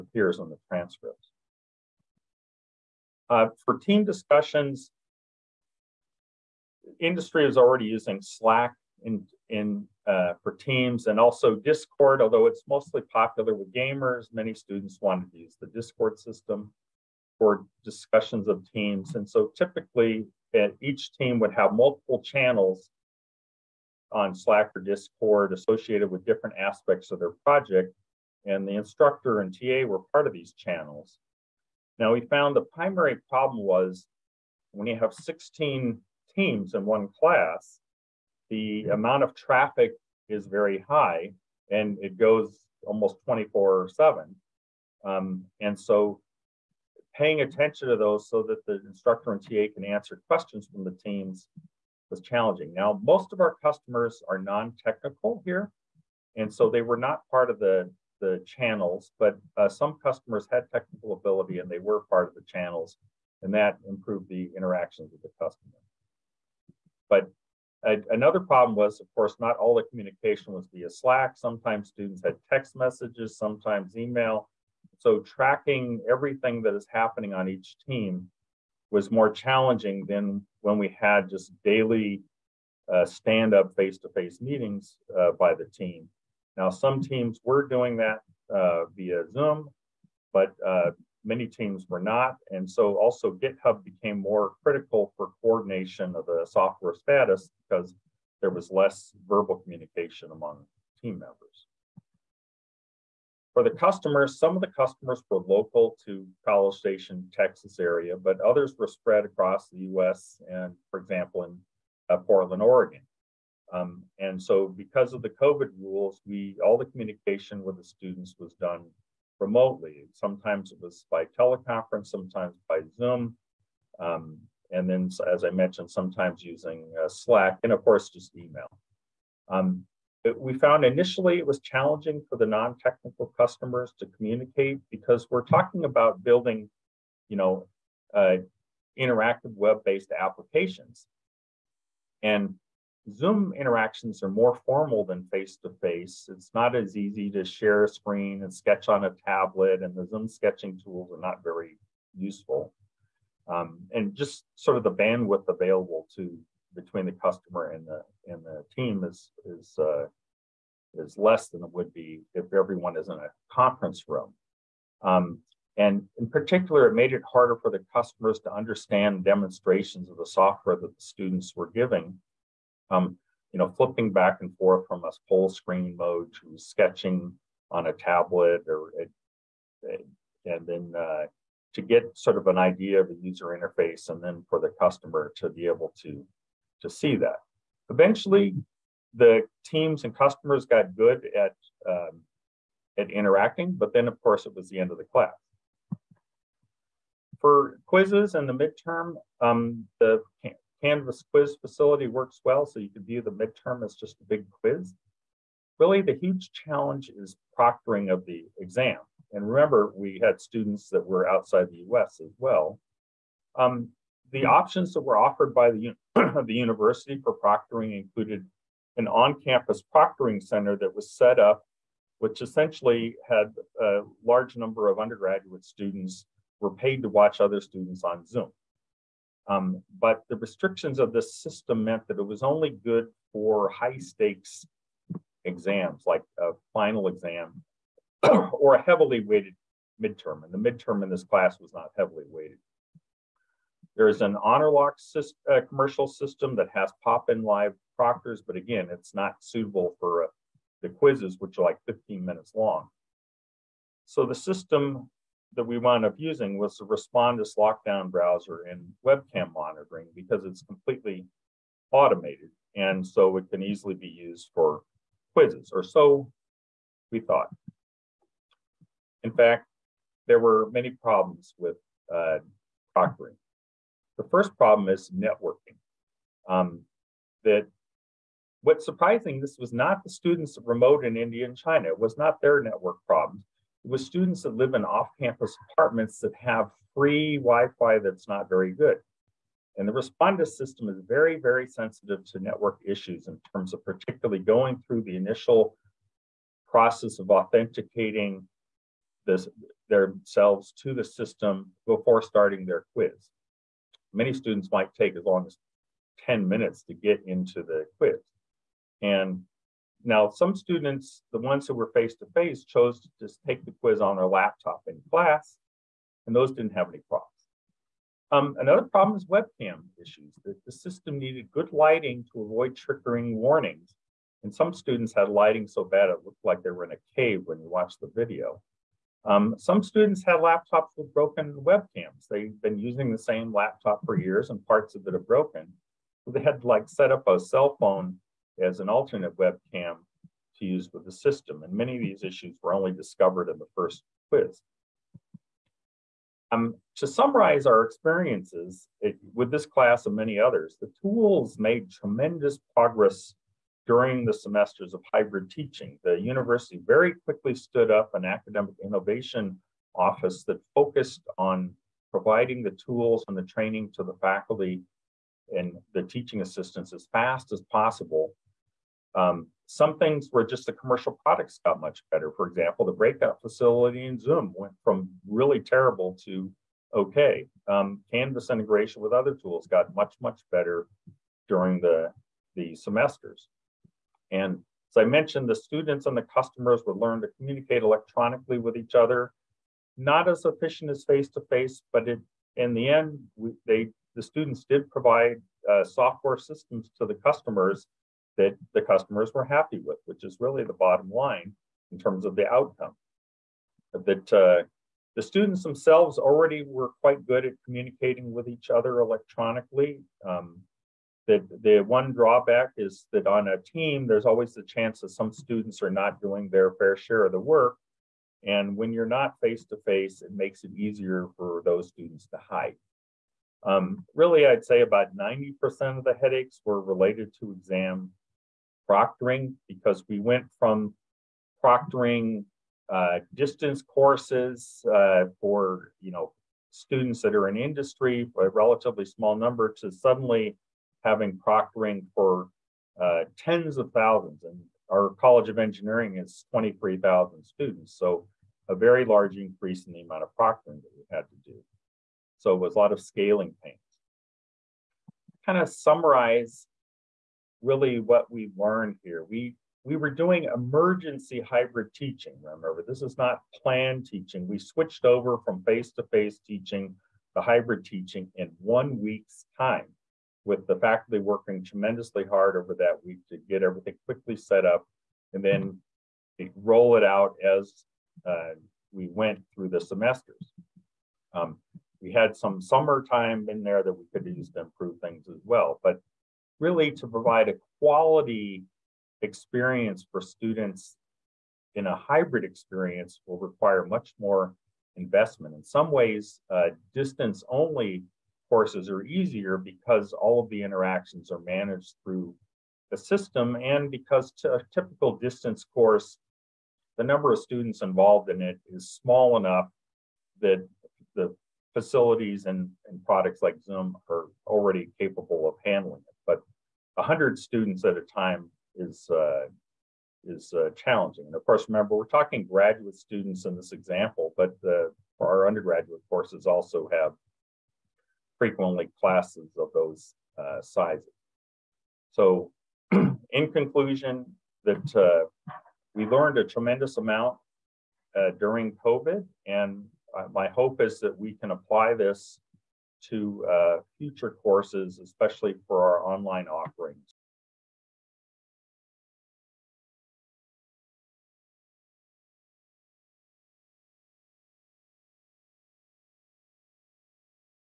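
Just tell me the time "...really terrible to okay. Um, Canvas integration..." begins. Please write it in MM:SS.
06:15.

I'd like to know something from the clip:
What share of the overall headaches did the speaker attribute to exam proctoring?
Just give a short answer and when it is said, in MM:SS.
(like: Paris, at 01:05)
90%, at 07:05.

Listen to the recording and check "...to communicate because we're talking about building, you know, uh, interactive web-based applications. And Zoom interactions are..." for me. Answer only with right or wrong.
right.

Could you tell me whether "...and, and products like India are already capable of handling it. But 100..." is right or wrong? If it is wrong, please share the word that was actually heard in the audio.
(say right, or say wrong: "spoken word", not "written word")
wrong: "Zoom", not "India".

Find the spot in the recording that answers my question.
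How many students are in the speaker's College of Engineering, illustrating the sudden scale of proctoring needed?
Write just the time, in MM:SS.
07:26.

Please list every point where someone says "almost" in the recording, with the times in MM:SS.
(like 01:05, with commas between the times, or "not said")
00:42.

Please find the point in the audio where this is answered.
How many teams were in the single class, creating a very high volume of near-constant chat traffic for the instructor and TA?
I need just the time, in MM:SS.
00:35.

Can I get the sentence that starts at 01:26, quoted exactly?
Now, some teams were doing that uh, via Zoom, but uh, many teams were not.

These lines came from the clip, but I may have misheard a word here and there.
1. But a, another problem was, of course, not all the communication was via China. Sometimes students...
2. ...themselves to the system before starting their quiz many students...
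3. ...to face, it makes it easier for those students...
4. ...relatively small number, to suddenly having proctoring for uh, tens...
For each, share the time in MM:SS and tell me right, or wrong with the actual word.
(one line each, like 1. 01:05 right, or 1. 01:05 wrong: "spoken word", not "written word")
1. 01:07 wrong: "Slack", not "China"
2. 04:59 right
3. 06:59 right
4. 07:18 right.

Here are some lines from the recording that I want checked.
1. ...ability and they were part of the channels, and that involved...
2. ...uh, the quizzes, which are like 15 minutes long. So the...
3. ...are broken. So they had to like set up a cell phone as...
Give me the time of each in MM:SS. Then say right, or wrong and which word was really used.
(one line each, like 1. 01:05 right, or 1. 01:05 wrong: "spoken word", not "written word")
1. 01:01 wrong: "improved", not "involved"
2. 04:10 right
3. 05:35 right.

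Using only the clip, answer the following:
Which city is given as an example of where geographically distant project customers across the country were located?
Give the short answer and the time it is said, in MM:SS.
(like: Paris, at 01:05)
Portland, Oregon, at 01:52.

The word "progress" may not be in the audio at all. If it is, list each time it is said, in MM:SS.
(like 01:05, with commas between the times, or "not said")
05:52.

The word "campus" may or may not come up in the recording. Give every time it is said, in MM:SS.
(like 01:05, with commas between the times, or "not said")
03:39, 04:44.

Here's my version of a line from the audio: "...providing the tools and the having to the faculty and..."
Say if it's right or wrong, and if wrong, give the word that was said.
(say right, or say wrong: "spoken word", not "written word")
wrong: "training", not "having".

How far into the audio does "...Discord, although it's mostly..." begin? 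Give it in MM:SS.
00:11.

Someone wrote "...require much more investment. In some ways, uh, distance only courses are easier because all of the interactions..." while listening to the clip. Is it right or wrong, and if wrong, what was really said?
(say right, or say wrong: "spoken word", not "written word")
right.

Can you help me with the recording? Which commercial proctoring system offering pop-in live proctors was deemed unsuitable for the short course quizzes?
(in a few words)
Honorlock.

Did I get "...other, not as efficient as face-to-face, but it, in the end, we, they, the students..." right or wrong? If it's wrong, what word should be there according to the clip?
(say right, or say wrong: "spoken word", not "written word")
right.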